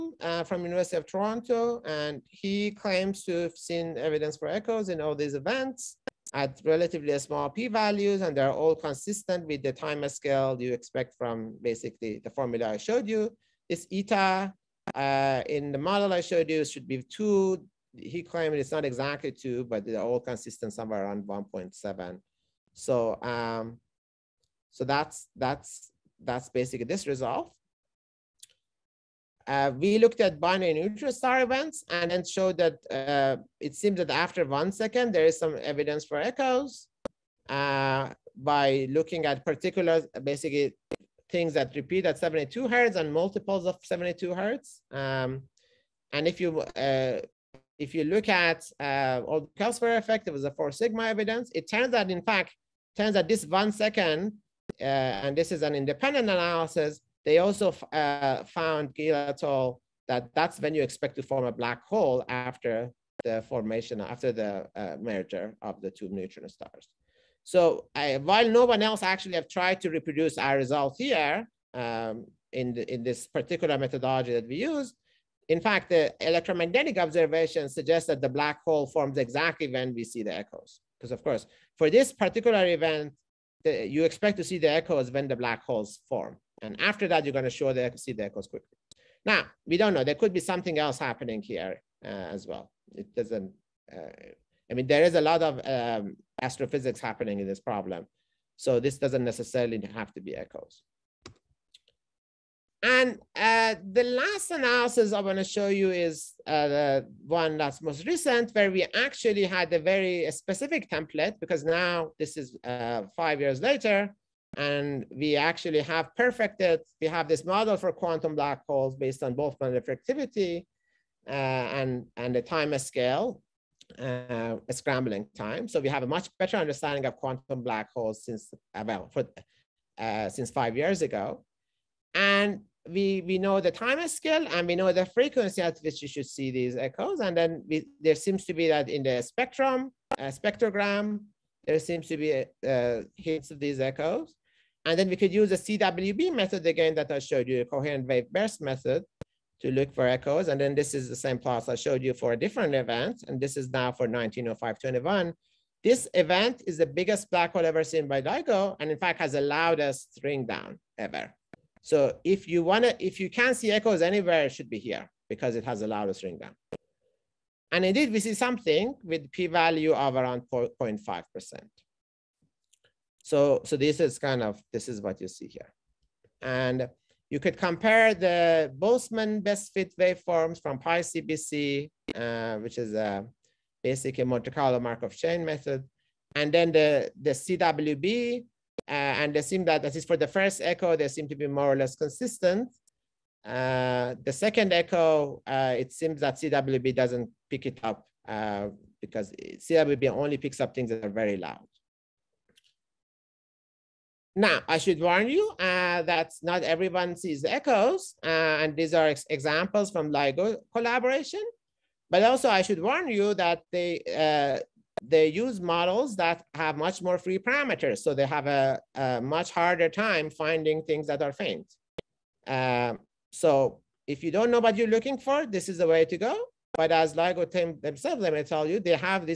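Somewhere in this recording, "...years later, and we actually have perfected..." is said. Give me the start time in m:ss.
1:53.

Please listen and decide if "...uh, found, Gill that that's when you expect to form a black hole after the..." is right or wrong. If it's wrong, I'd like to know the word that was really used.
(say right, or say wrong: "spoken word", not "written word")
right.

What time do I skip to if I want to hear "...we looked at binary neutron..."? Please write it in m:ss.
0:29.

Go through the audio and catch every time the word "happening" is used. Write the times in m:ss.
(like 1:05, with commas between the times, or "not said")
1:30, 1:36.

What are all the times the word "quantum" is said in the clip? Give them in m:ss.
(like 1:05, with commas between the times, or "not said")
1:57, 2:07.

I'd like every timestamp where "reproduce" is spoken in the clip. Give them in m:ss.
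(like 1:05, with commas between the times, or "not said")
1:09.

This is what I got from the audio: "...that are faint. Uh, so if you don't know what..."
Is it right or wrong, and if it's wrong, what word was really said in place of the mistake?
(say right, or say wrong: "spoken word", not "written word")
right.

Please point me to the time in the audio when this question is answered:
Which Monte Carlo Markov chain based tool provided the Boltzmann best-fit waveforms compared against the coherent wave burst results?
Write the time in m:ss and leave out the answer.
3:00.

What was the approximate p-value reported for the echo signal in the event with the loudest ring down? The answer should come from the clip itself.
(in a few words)
0.5%.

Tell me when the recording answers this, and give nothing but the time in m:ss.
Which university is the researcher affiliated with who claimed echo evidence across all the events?
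0:00.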